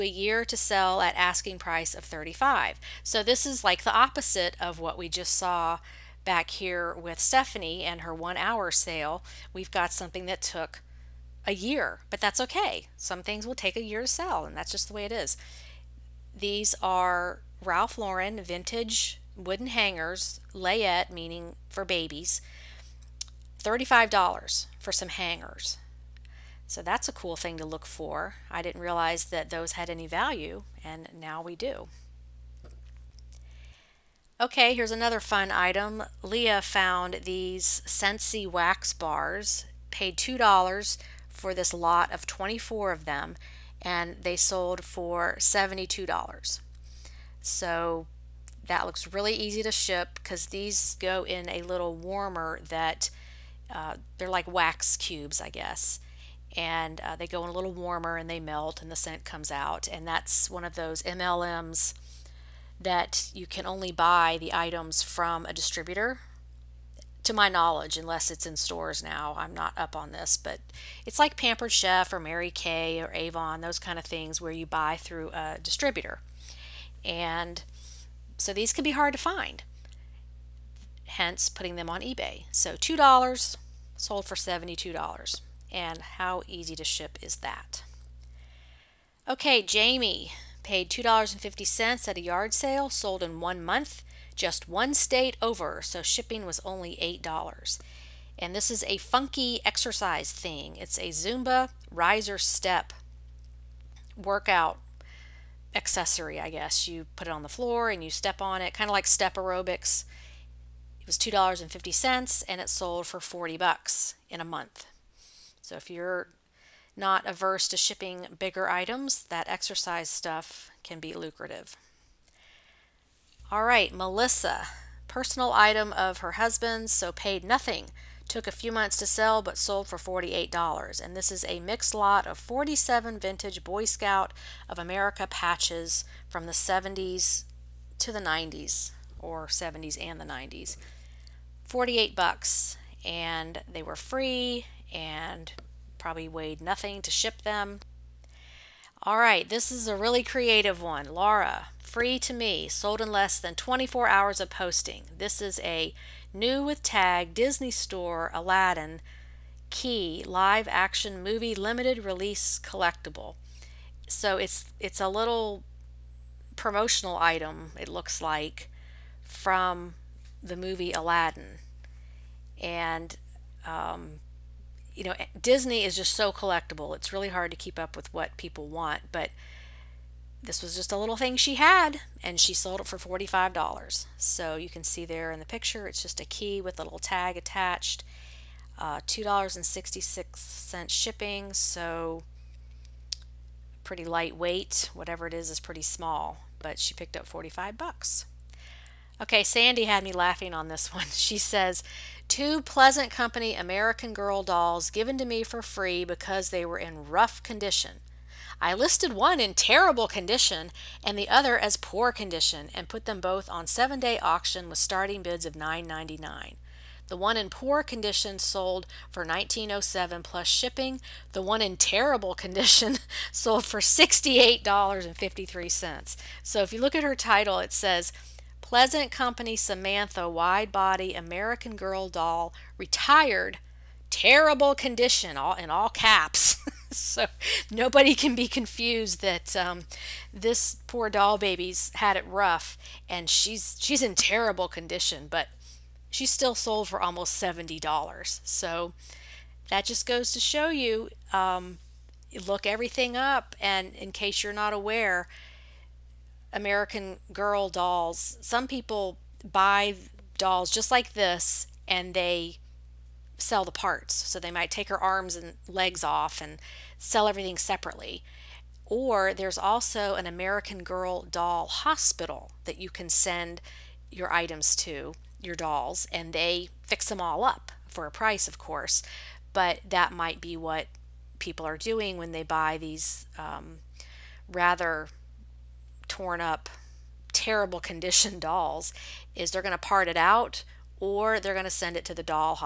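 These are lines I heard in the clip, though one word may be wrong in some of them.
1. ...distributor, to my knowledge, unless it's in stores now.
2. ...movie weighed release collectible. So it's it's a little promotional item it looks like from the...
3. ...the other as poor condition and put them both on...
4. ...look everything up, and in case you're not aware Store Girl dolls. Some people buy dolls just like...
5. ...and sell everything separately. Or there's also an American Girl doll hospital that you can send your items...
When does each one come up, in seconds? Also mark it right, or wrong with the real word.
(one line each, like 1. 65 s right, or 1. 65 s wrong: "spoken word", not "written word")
1. 65 s right
2. 161 s wrong: "limited", not "weighed"
3. 211 s right
4. 252 s wrong: "American", not "Store"
5. 266 s right.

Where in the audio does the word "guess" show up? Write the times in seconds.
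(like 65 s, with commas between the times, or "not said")
55 s, 106 s.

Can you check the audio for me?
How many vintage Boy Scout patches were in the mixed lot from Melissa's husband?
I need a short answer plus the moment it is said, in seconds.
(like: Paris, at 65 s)
47, at 132 s.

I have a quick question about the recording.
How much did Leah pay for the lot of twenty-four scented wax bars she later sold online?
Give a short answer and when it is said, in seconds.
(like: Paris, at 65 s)
$2, at 39 s.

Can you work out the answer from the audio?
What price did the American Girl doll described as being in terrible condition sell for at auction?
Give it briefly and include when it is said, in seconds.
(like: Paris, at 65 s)
$68.53, at 223 s.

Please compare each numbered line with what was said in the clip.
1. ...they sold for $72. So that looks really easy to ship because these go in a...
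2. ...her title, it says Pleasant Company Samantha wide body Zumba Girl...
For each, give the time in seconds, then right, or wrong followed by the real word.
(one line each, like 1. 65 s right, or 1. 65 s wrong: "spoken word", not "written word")
1. 44 s right
2. 227 s wrong: "American", not "Zumba".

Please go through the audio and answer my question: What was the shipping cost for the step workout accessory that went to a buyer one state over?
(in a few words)
$8.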